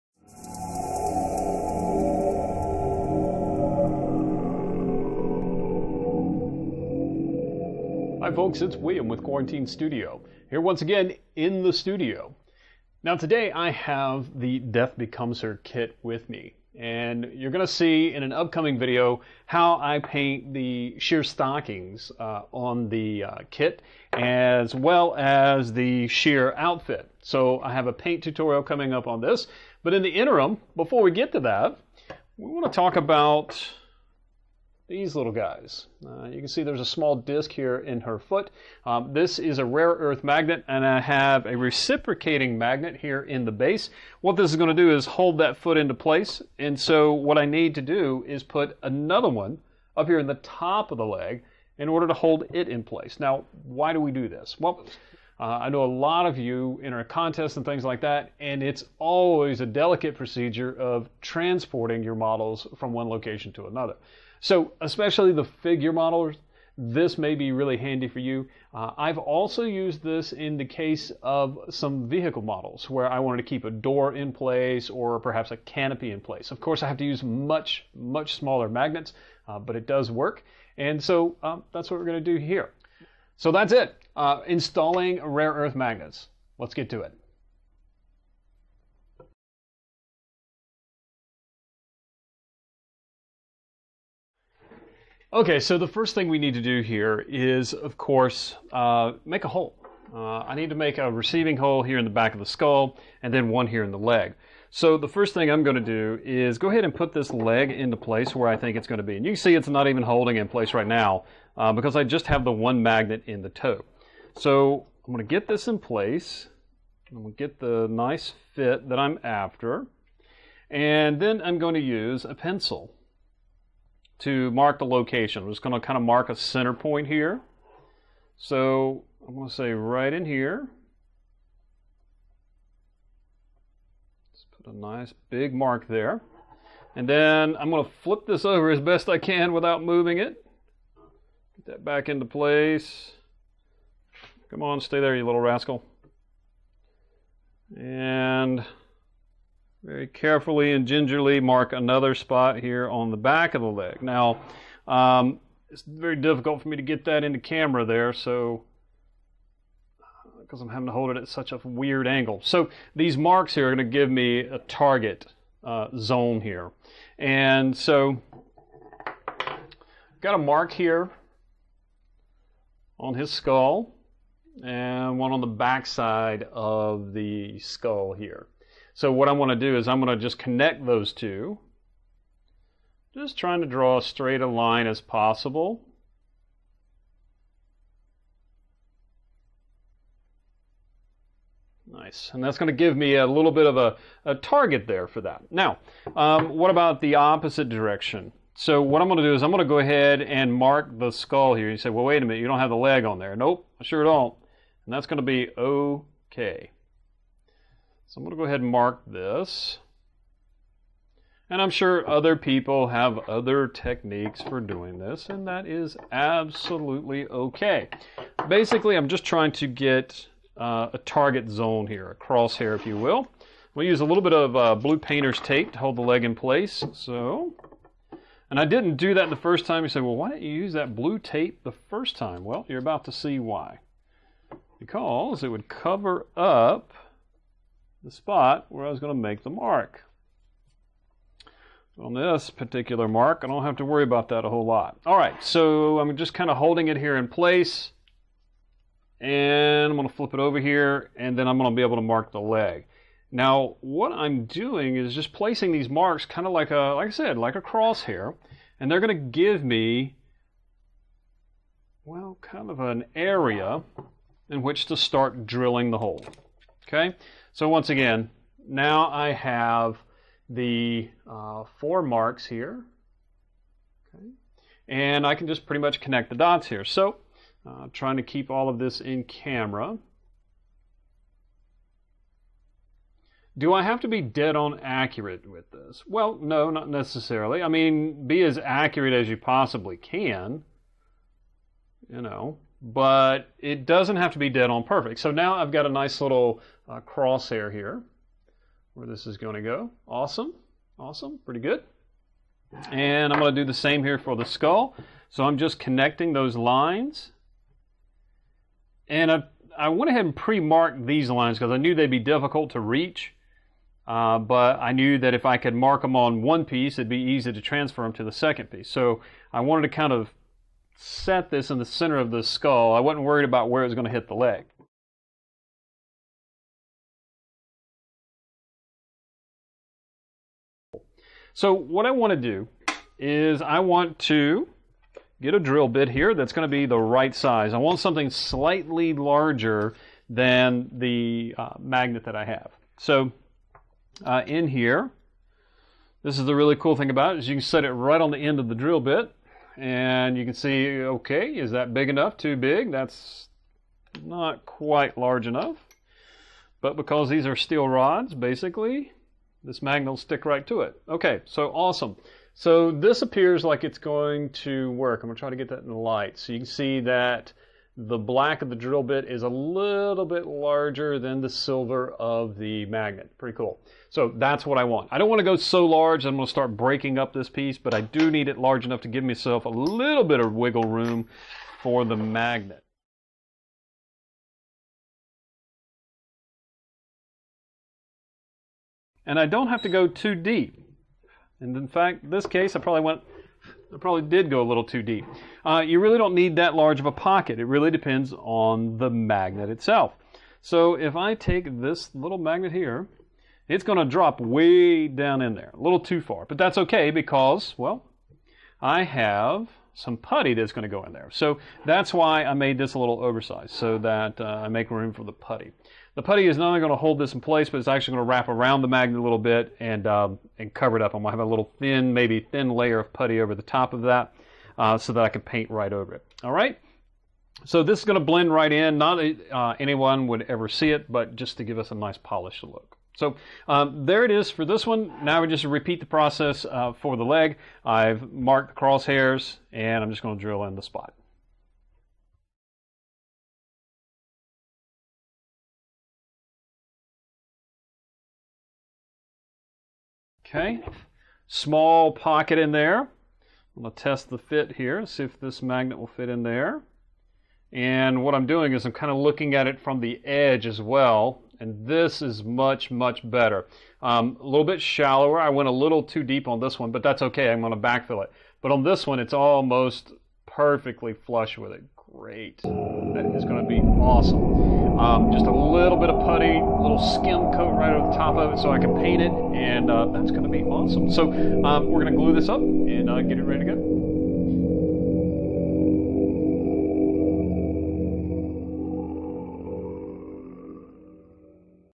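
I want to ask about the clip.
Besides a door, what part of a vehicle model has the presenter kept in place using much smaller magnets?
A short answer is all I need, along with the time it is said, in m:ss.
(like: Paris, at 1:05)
canopy, at 1:15.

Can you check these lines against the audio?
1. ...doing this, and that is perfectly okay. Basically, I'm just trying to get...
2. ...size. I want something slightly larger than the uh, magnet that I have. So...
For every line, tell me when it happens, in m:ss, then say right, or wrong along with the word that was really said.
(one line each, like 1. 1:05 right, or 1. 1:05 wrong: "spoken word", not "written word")
1. 3:34 wrong: "absolutely", not "perfectly"
2. 5:37 right.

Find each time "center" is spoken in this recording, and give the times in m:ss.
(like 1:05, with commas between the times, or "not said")
2:06, 5:21.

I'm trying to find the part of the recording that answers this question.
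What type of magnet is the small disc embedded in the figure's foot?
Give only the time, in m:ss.
0:39.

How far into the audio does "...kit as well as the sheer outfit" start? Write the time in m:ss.
0:23.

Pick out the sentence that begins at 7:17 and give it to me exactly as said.
I've marked the crosshairs and I'm just going to drill in the spot.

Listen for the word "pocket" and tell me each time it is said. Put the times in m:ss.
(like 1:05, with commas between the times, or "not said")
6:37, 7:32.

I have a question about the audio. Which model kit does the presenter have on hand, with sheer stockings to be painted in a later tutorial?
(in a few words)
Death Becomes Her.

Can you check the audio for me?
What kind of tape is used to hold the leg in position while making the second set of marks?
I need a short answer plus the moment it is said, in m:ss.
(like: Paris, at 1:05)
blue painter's tape, at 3:44.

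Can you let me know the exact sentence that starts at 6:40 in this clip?
So if I take this little magnet here, it's going to drop way down in there, a little too far.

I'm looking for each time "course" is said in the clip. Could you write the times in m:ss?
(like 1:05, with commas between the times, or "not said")
1:16, 1:37.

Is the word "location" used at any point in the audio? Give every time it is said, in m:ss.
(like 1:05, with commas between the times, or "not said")
1:03, 2:04.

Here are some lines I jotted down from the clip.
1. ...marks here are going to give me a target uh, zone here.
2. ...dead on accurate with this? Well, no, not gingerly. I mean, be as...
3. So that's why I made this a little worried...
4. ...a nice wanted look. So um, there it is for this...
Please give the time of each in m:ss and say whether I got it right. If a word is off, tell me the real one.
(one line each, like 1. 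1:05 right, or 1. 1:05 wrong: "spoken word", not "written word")
1. 2:43 right
2. 4:44 wrong: "necessarily", not "gingerly"
3. 6:51 wrong: "oversized", not "worried"
4. 7:11 wrong: "polished", not "wanted".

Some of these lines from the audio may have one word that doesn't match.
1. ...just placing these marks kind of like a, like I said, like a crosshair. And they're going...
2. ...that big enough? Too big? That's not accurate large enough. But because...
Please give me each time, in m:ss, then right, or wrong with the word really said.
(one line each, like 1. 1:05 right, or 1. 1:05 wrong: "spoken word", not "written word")
1. 4:15 right
2. 5:51 wrong: "quite", not "accurate".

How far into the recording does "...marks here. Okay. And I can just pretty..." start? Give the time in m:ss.
4:32.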